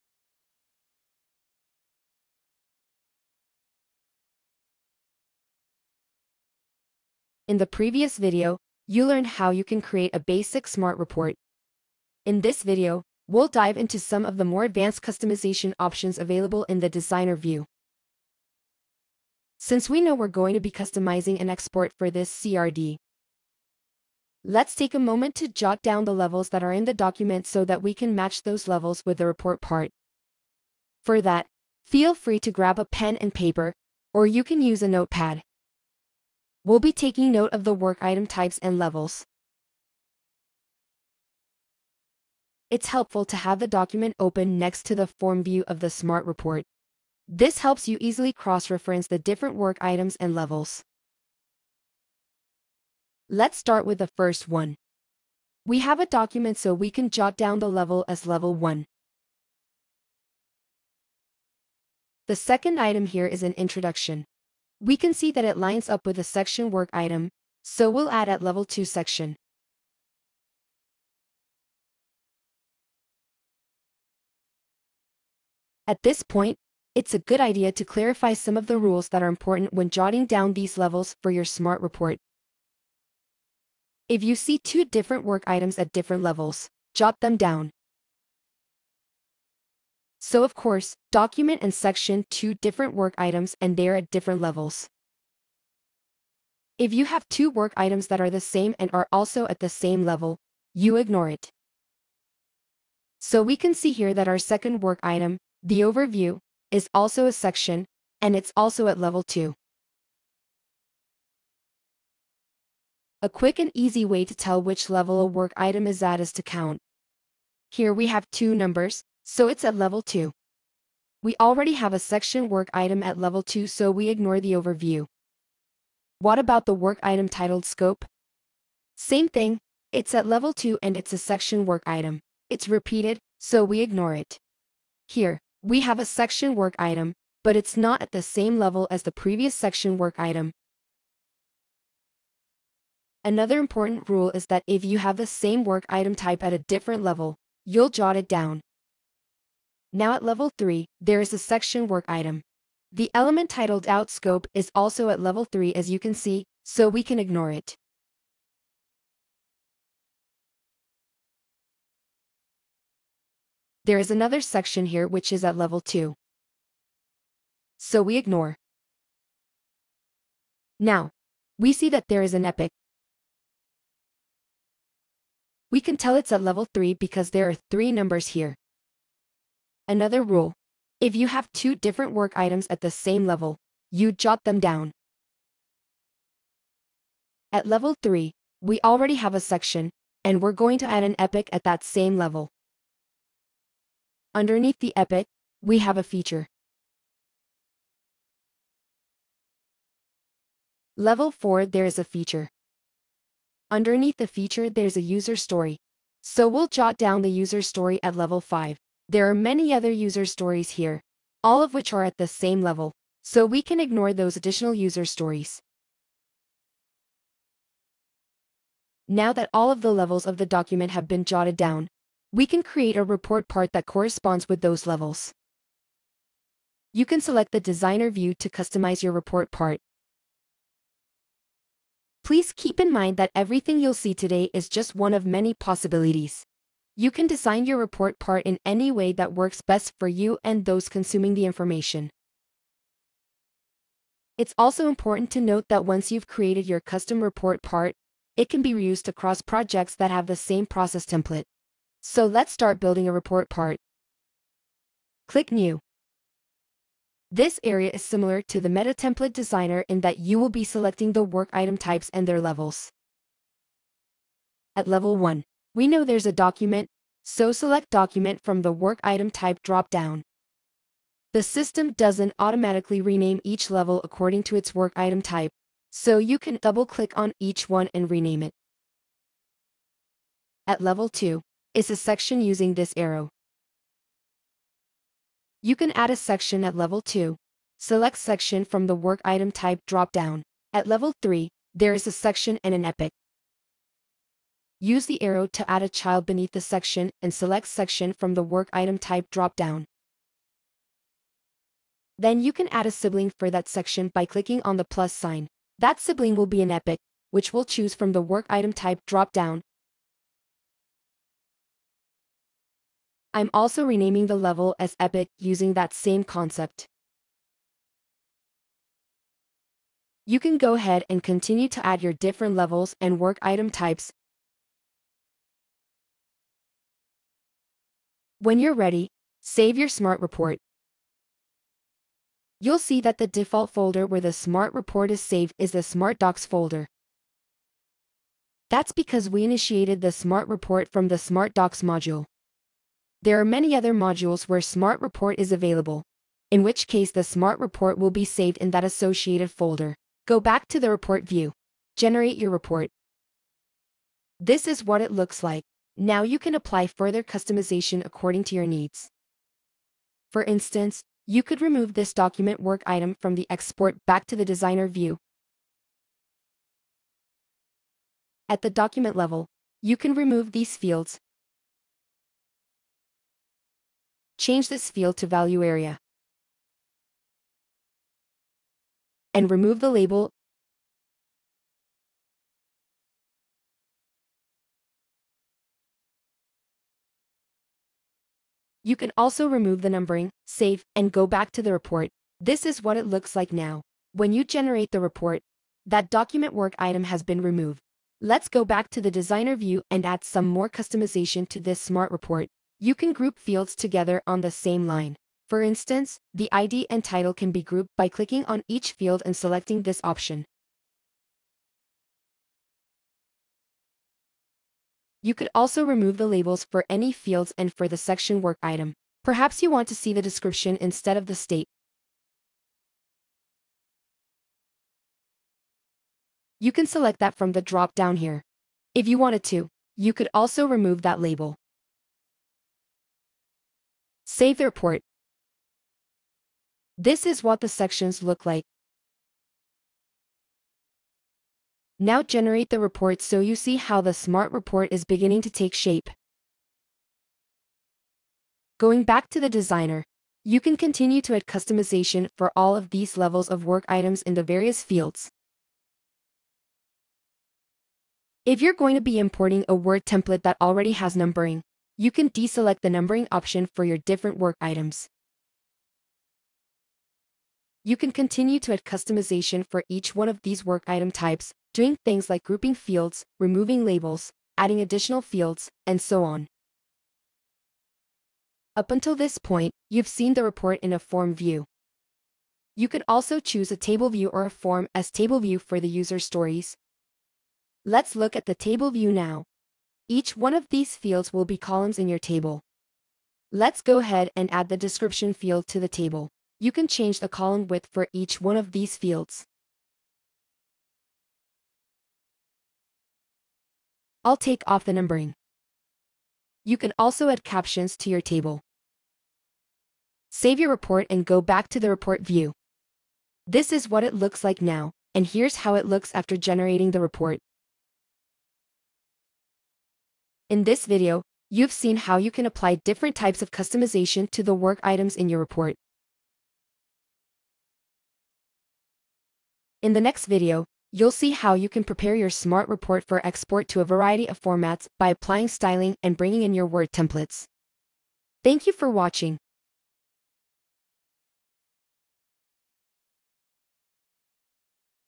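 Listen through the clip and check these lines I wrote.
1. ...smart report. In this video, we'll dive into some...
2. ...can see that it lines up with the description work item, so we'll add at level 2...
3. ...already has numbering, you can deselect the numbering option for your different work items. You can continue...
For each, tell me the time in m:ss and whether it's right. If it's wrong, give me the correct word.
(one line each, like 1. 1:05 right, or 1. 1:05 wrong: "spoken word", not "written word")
1. 0:10 right
2. 1:04 wrong: "section", not "description"
3. 7:40 right.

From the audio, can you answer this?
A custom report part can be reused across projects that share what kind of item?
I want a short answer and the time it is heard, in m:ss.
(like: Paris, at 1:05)
Process template, at 4:10.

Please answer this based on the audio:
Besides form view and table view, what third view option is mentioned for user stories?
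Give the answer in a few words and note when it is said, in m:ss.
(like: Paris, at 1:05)
Form as table, at 8:04.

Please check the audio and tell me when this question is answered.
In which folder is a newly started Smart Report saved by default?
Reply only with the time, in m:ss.
5:35.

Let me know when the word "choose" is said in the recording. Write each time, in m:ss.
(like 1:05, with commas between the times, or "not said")
5:07, 8:03.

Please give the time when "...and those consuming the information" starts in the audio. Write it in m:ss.
4:00.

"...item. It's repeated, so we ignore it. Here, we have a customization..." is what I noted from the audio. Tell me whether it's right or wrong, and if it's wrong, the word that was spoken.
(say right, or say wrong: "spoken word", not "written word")
wrong: "section", not "customization".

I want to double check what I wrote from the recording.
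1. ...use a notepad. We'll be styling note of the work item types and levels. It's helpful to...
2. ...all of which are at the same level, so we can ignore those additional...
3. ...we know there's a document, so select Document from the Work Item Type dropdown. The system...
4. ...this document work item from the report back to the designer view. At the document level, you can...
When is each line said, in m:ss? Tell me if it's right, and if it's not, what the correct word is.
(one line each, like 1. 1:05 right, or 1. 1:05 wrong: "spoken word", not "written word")
1. 0:34 wrong: "taking", not "styling"
2. 3:31 right
3. 4:25 right
4. 6:01 wrong: "export", not "report".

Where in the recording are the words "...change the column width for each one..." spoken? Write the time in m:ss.
8:16.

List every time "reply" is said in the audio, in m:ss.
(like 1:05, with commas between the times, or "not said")
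not said.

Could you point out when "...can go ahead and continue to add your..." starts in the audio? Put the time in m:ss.
5:20.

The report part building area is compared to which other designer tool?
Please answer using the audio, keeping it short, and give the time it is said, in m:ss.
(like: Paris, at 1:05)
Meta Template Designer, at 4:18.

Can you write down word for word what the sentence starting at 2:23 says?
Another important rule is that if you have the same work item type at a different level, you'll jot it down.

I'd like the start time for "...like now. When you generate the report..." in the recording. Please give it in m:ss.
6:33.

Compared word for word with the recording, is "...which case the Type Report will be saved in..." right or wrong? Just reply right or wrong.
wrong.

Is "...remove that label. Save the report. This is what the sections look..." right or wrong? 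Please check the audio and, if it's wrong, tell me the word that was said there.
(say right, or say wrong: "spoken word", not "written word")
right.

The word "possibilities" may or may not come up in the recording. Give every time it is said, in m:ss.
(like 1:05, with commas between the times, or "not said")
3:55.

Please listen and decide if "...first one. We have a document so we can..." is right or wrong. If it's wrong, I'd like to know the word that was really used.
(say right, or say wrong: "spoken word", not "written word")
right.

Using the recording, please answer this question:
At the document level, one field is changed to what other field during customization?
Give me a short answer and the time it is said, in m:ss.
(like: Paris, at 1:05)
Value area, at 6:15.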